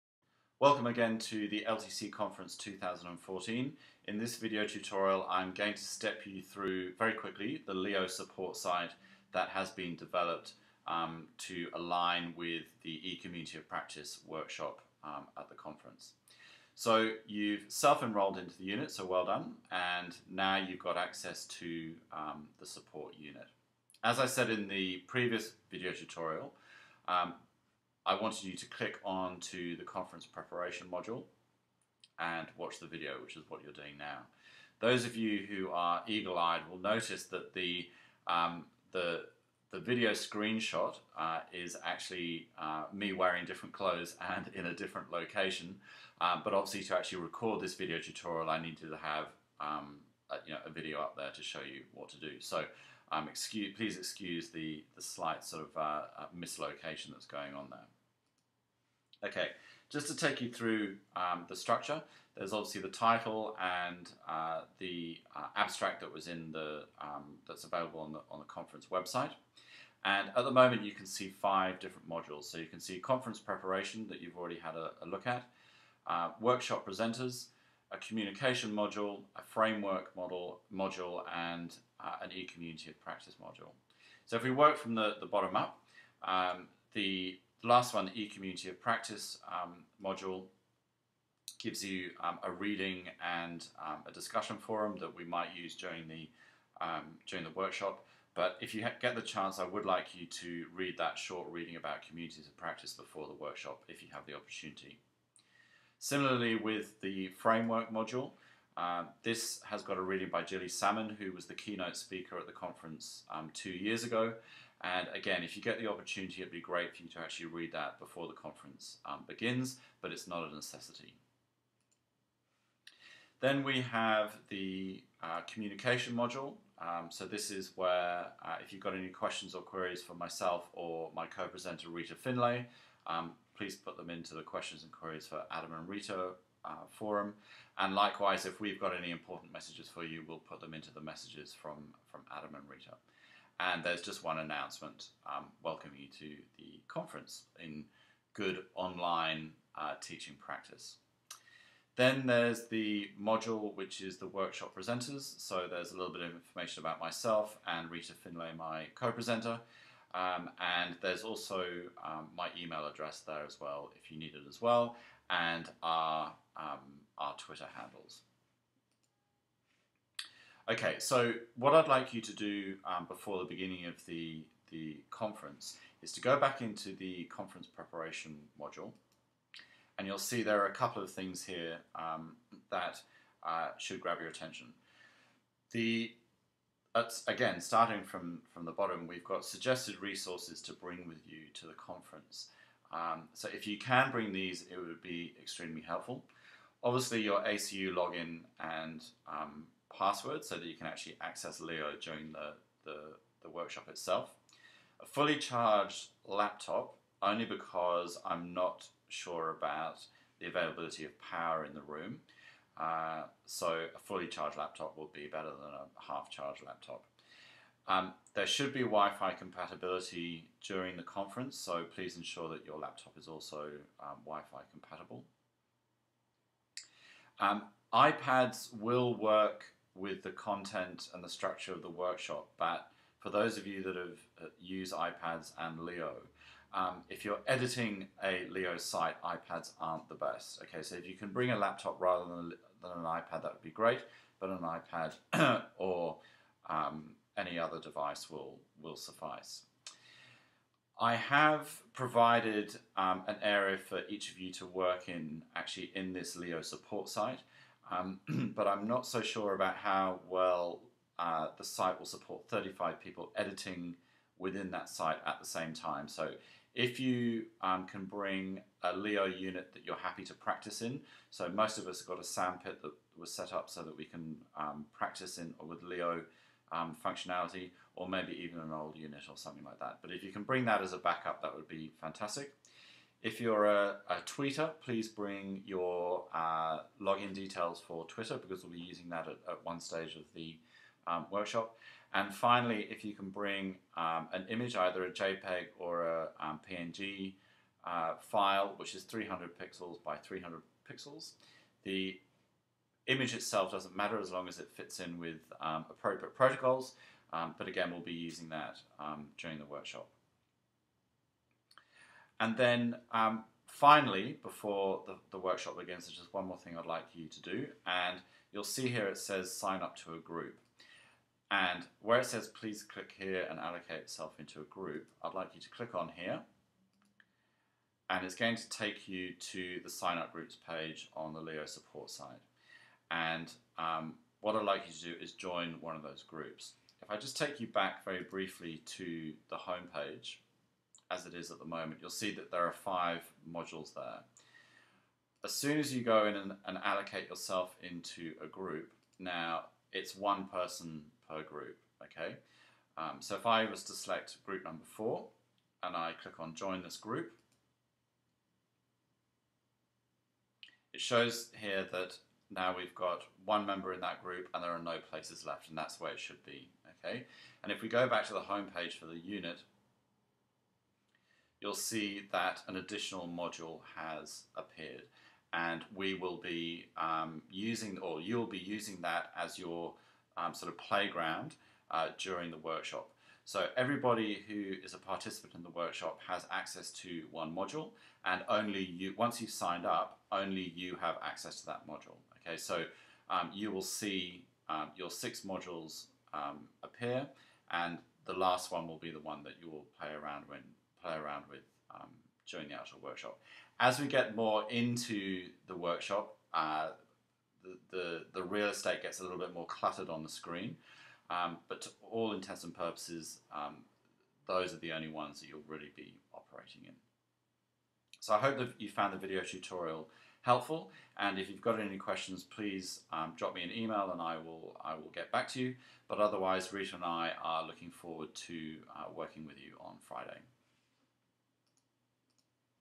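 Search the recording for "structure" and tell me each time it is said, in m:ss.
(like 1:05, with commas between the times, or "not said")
1:01, 3:51.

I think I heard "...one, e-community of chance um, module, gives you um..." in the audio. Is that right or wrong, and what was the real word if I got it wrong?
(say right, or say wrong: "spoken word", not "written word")
wrong: "practice", not "chance".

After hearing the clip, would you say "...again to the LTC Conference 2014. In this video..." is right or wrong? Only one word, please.
right.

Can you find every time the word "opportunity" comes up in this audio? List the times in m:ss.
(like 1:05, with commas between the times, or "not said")
1:44, 1:55.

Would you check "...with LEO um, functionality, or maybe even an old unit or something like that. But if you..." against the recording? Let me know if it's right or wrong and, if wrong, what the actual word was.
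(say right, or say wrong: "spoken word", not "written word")
right.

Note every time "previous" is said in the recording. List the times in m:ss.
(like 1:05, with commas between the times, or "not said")
0:25.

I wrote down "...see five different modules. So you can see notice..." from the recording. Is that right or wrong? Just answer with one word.
wrong.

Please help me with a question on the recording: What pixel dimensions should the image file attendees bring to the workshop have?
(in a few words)
300 by 300 pixels.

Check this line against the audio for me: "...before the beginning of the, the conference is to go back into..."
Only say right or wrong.
right.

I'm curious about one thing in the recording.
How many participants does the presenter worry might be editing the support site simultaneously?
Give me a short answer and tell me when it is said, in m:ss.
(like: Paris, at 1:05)
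35, at 4:22.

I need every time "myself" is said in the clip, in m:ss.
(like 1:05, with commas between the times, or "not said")
2:10, 2:36.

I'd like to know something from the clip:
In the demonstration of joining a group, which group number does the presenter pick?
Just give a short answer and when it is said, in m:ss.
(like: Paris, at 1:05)
4, at 5:54.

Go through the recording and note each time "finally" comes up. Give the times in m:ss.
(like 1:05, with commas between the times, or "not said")
4:52, 5:13.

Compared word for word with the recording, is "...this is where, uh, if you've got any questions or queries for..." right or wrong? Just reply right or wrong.
right.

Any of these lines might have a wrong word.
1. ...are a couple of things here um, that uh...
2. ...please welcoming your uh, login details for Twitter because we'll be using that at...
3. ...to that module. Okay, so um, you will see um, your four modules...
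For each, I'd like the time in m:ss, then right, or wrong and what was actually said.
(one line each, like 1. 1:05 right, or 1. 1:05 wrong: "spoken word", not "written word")
1. 3:00 right
2. 4:44 wrong: "bring", not "welcoming"
3. 6:31 wrong: "six", not "four".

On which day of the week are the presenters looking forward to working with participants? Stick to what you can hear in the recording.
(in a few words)
Friday.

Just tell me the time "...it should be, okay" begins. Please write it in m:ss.
6:06.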